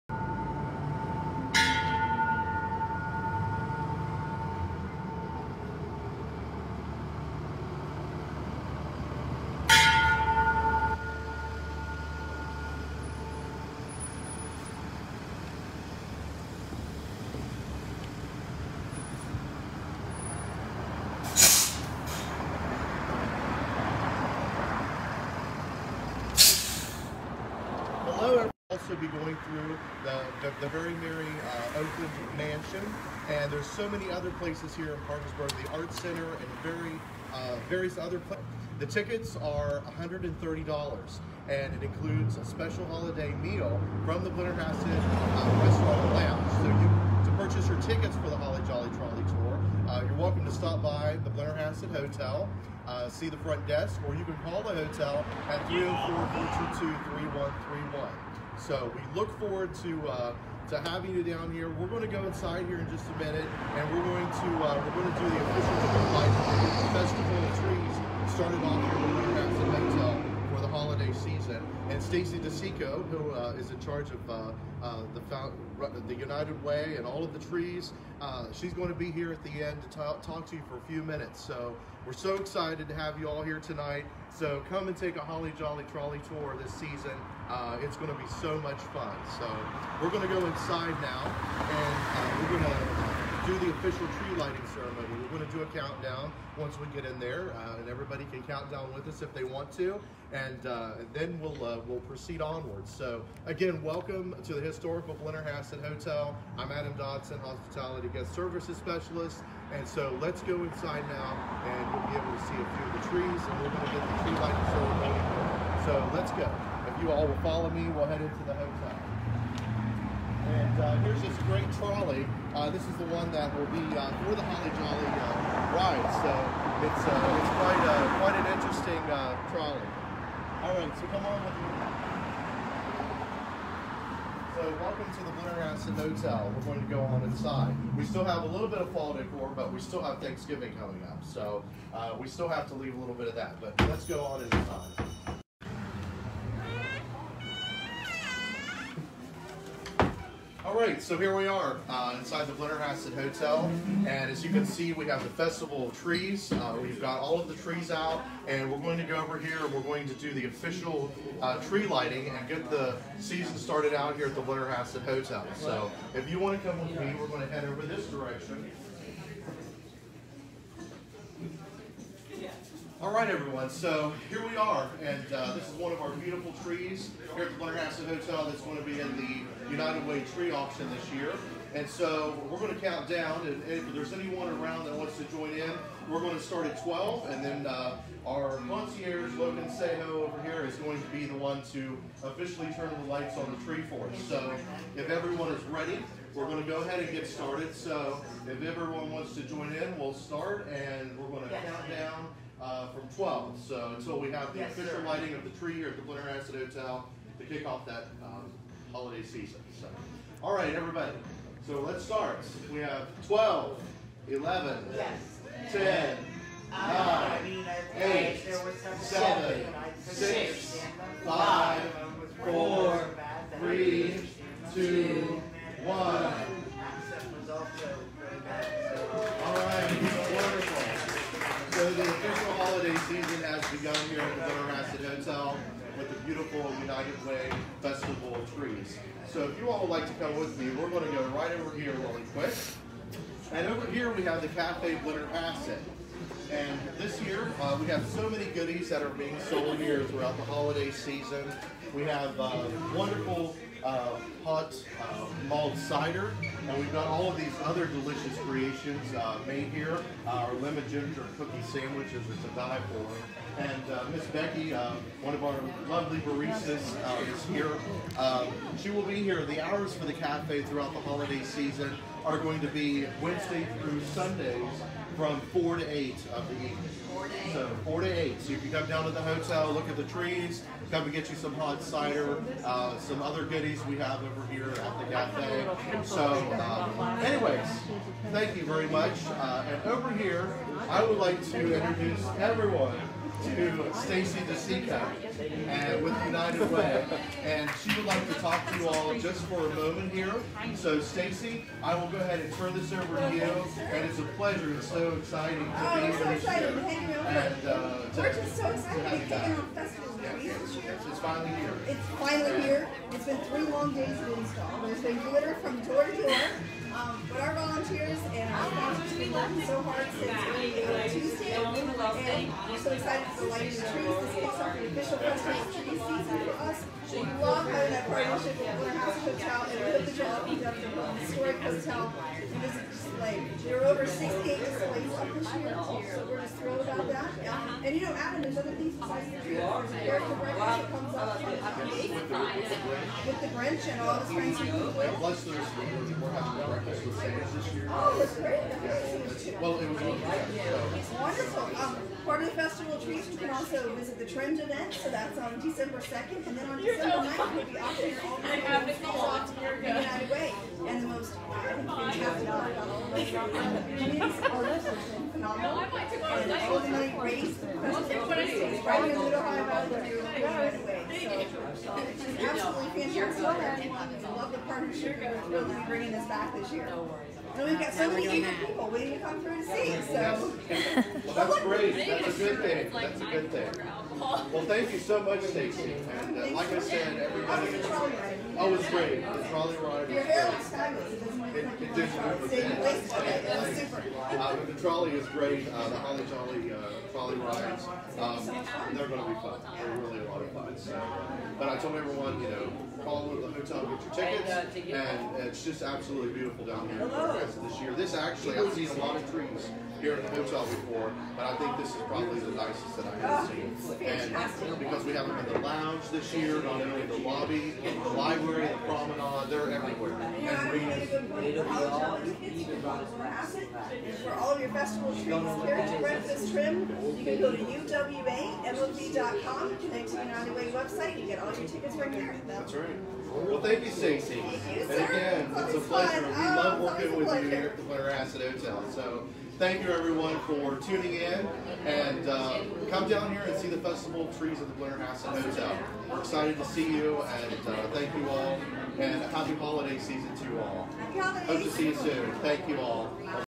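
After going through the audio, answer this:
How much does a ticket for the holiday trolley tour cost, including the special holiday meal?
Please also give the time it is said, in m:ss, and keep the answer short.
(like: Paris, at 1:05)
$130, at 0:39.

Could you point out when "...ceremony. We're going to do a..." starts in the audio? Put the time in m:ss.
1:34.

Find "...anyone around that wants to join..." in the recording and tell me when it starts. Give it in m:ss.
3:04.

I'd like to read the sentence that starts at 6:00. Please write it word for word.
And the most, I think, fantastic part about all of those communities are I absolutely fantastic.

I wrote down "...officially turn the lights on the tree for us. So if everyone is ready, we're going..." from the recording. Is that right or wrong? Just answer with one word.
right.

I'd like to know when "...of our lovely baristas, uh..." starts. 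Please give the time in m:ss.
4:25.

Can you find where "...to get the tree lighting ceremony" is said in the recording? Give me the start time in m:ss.
1:53.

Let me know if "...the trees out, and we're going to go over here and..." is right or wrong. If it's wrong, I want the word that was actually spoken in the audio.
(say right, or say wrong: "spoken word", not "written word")
right.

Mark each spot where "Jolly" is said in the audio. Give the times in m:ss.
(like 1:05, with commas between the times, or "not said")
0:48, 1:25, 2:04, 6:36.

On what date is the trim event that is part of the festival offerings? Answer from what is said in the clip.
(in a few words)
December 2nd.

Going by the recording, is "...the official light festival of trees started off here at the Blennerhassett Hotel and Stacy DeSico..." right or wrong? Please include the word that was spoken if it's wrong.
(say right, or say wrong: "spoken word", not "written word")
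right.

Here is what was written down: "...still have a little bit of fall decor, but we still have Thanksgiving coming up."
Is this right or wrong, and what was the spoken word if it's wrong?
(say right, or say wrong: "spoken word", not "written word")
right.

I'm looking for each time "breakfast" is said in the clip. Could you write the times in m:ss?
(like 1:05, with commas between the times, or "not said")
5:40, 5:46, 7:06.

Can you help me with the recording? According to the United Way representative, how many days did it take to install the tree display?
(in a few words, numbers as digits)
3.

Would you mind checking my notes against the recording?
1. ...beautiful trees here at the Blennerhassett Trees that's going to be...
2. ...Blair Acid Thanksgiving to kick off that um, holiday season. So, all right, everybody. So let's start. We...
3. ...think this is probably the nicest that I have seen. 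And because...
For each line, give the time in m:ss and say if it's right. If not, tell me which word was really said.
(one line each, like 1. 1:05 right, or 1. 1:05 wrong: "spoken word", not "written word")
1. 2:56 wrong: "Hotel", not "Trees"
2. 3:26 wrong: "Hotel", not "Thanksgiving"
3. 6:51 right.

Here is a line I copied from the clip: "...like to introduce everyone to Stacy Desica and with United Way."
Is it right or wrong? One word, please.
right.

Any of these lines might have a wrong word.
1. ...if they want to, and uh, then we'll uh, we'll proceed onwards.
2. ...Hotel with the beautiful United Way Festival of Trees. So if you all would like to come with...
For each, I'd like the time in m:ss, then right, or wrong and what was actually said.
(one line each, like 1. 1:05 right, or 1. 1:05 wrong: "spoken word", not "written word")
1. 1:39 right
2. 3:55 right.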